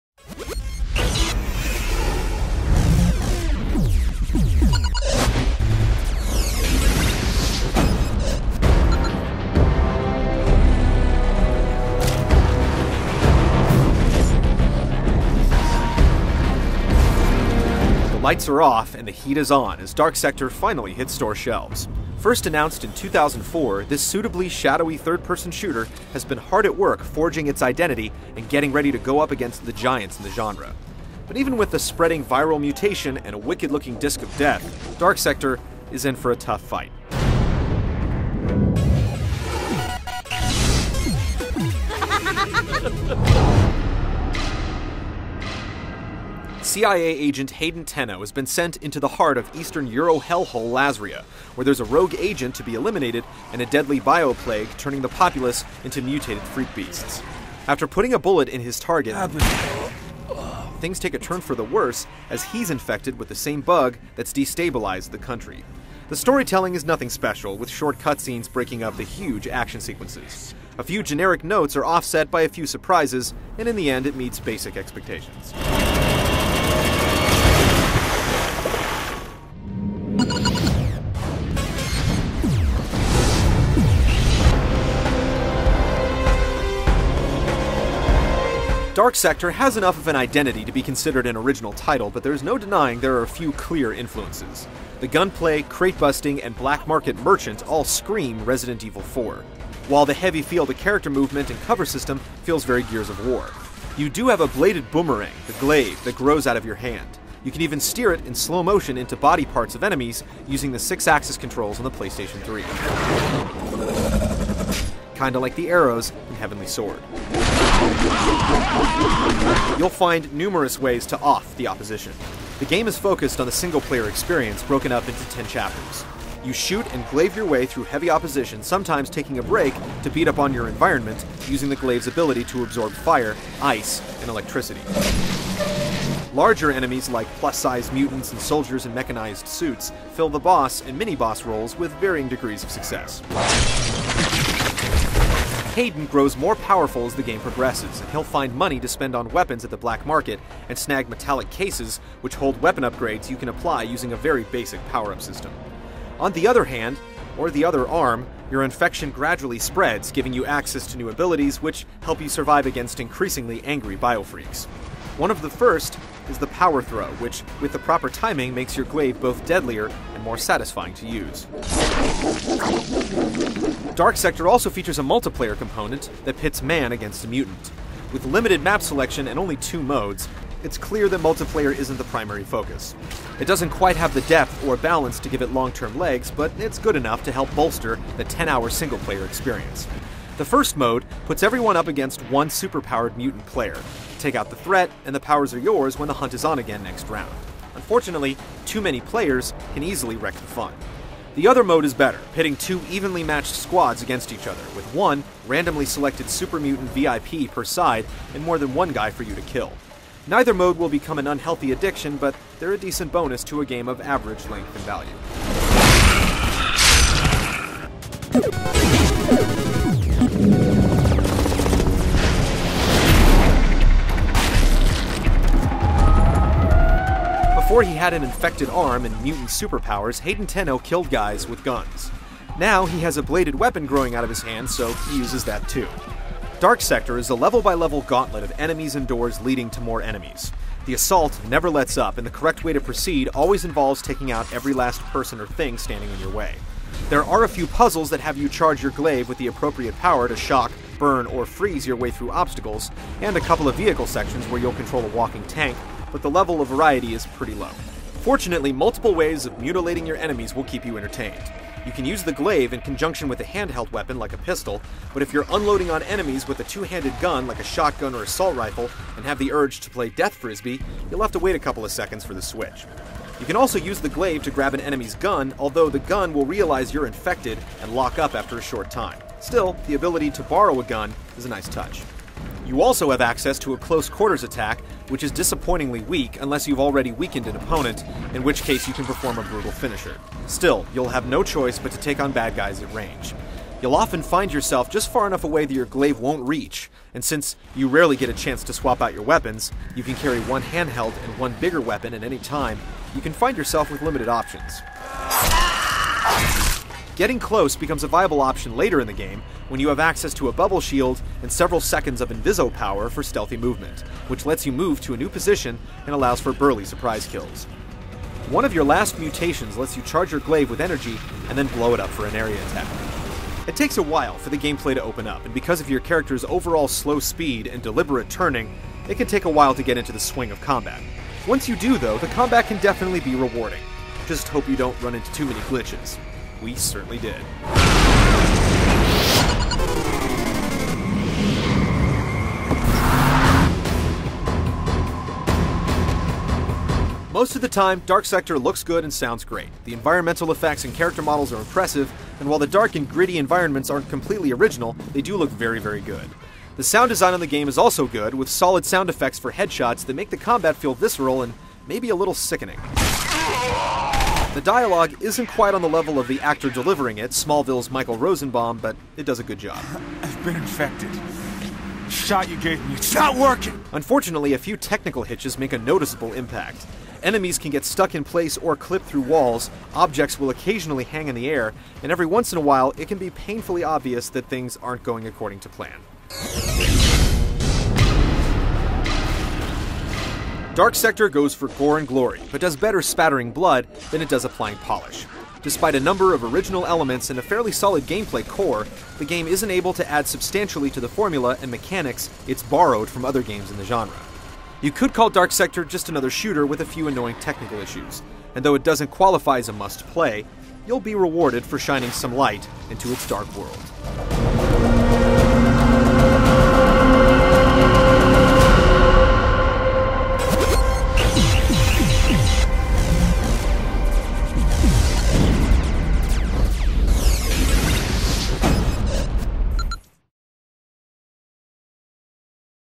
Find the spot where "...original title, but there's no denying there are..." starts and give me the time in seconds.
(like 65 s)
91 s.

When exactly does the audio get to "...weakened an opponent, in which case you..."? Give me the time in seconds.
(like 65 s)
287 s.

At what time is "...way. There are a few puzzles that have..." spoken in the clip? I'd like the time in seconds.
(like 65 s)
246 s.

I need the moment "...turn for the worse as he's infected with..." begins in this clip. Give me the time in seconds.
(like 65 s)
61 s.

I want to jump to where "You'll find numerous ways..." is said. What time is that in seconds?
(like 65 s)
119 s.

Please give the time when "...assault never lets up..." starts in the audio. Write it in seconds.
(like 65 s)
240 s.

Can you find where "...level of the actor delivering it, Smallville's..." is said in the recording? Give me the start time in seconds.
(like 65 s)
365 s.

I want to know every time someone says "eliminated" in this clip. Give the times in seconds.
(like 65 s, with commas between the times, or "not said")
52 s.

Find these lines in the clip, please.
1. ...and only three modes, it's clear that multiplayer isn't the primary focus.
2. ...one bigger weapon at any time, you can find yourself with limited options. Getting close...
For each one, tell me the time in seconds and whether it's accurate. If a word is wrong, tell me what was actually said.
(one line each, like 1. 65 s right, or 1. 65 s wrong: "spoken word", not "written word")
1. 179 s wrong: "two", not "three"
2. 301 s right.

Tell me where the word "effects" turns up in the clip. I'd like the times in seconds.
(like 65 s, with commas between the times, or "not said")
350 s, 359 s.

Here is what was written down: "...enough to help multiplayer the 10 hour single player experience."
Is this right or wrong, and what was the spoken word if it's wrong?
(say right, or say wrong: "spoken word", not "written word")
wrong: "bolster", not "multiplayer".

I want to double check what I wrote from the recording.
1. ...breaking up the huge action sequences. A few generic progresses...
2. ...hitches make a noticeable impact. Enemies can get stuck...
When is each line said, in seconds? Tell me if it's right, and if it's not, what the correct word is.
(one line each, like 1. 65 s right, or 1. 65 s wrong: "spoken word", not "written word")
1. 68 s wrong: "notes", not "progresses"
2. 375 s right.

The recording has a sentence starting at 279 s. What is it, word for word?
Still, the ability to borrow a gun is a nice touch.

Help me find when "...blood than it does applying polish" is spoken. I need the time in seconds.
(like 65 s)
393 s.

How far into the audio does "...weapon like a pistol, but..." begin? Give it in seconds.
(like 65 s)
263 s.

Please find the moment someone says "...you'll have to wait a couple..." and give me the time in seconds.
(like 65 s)
271 s.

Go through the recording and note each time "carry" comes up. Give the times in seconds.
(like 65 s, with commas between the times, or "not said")
300 s.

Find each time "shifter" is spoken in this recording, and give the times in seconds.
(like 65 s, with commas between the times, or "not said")
not said.